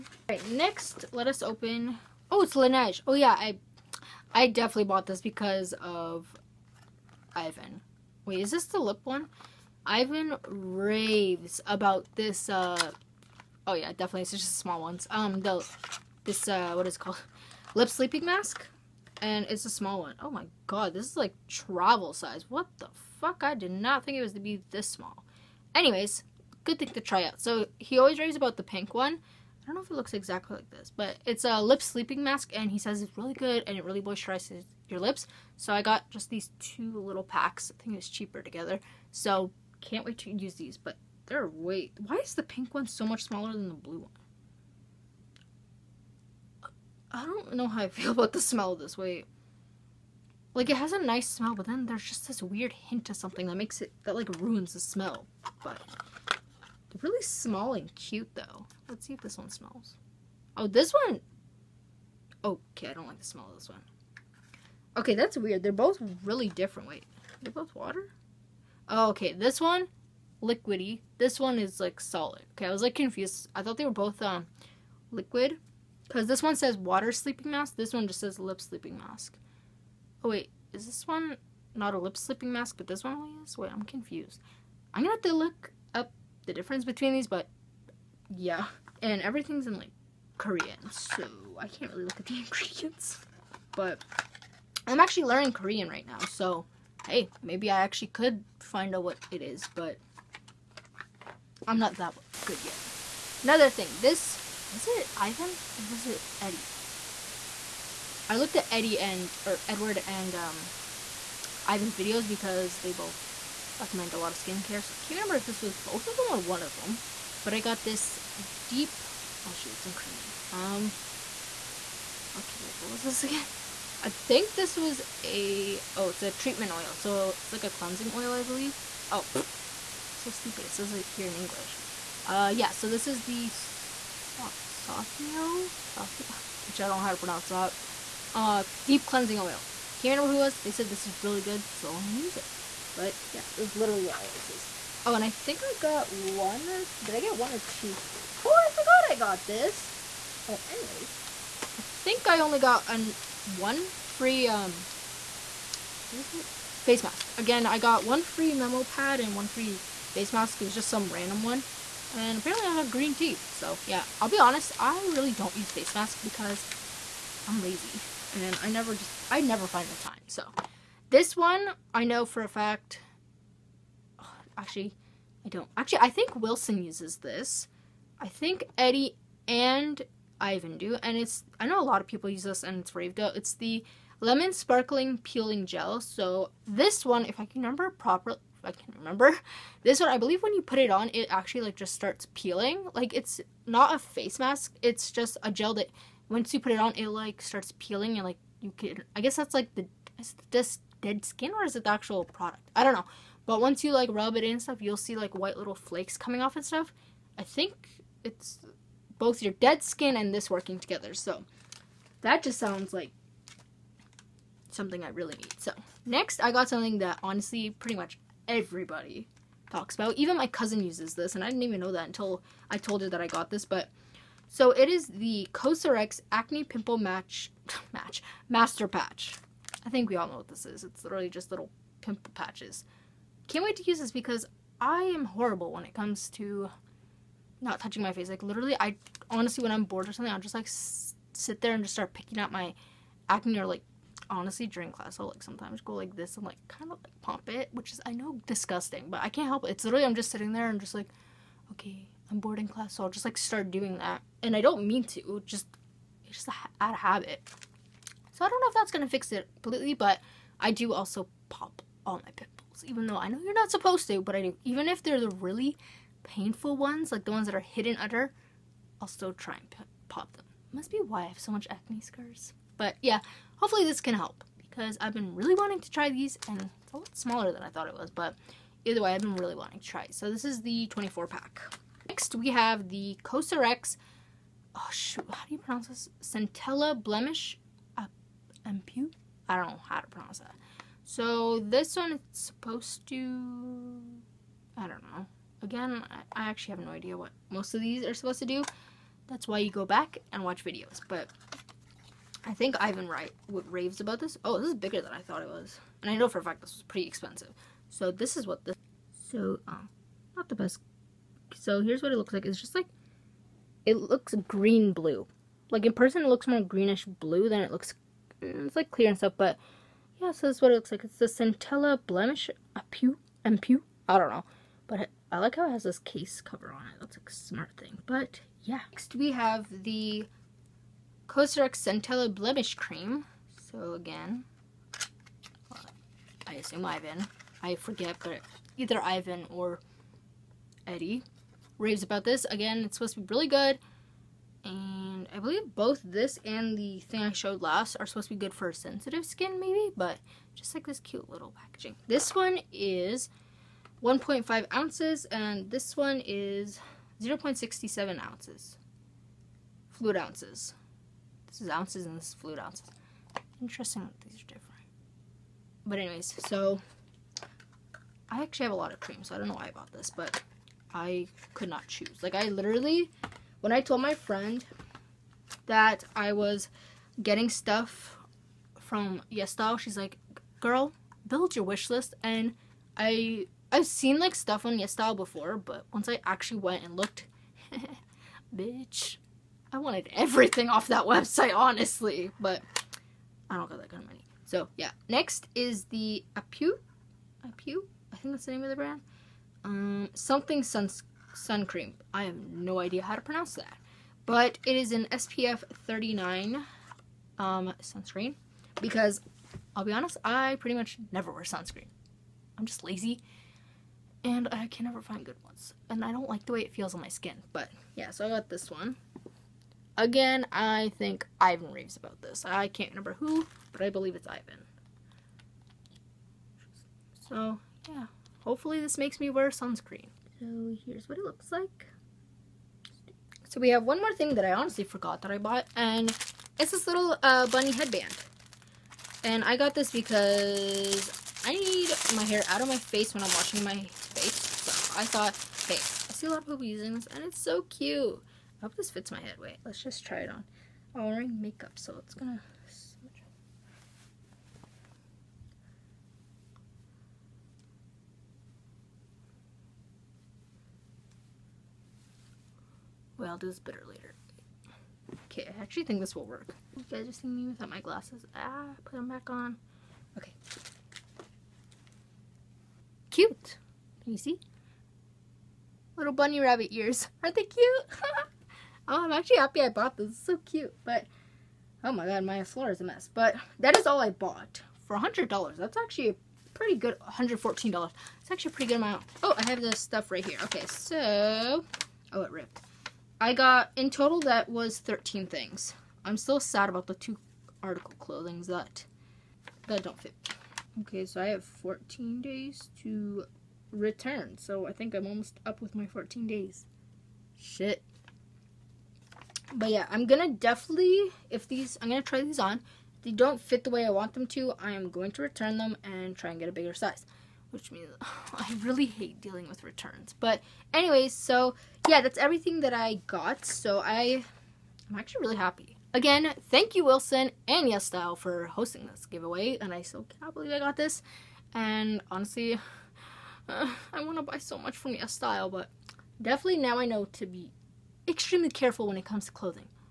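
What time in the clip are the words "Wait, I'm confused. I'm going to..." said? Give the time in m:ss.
1:23.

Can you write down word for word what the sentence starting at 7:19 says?
And I got this because I need my hair out of my face when I'm washing my face.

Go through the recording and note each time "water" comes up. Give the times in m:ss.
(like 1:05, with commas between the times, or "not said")
1:07, 1:16.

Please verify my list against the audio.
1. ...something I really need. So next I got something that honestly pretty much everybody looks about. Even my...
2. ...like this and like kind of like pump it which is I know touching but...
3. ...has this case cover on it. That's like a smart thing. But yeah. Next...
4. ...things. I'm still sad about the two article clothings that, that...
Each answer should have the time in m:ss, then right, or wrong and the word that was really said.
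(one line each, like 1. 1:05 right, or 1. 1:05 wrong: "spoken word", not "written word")
1. 3:34 wrong: "talks", not "looks"
2. 4:05 wrong: "disgusting", not "touching"
3. 5:25 right
4. 8:15 right.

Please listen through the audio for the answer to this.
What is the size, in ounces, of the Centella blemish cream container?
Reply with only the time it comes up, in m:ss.
5:54.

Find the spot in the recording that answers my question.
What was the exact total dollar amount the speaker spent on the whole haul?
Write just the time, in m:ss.
8:07.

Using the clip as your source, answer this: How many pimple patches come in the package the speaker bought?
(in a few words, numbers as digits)
24.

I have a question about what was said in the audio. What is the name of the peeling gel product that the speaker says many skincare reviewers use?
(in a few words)
Lemon sparkling peeling gel.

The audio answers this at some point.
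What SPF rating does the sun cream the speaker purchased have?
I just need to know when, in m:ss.
6:45.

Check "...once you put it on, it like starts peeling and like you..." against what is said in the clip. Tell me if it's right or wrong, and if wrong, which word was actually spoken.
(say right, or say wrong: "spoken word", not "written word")
right.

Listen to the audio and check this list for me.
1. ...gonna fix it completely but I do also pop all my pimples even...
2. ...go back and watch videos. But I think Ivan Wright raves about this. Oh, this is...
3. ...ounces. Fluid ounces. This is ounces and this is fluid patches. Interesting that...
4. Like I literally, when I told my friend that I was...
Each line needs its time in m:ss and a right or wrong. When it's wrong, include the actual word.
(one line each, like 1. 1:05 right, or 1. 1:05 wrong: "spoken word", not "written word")
1. 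4:18 right
2. 4:59 right
3. 5:58 wrong: "ounces", not "patches"
4. 6:12 right.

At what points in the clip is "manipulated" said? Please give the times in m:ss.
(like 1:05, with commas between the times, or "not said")
not said.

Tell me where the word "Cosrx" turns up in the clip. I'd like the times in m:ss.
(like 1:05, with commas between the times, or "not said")
3:45, 4:43, 5:31.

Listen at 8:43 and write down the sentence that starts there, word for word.
So I, I'm actually really happy.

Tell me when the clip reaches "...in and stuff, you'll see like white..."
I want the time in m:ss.
3:24.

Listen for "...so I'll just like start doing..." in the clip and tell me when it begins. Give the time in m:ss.
4:12.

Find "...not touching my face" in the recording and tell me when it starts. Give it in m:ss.
3:57.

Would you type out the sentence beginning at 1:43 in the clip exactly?
Another thing, this was it Ivan or was it Eddie?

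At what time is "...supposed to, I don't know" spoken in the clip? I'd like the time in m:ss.
4:52.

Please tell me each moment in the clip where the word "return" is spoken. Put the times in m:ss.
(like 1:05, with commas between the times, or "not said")
8:23, 8:35, 8:39.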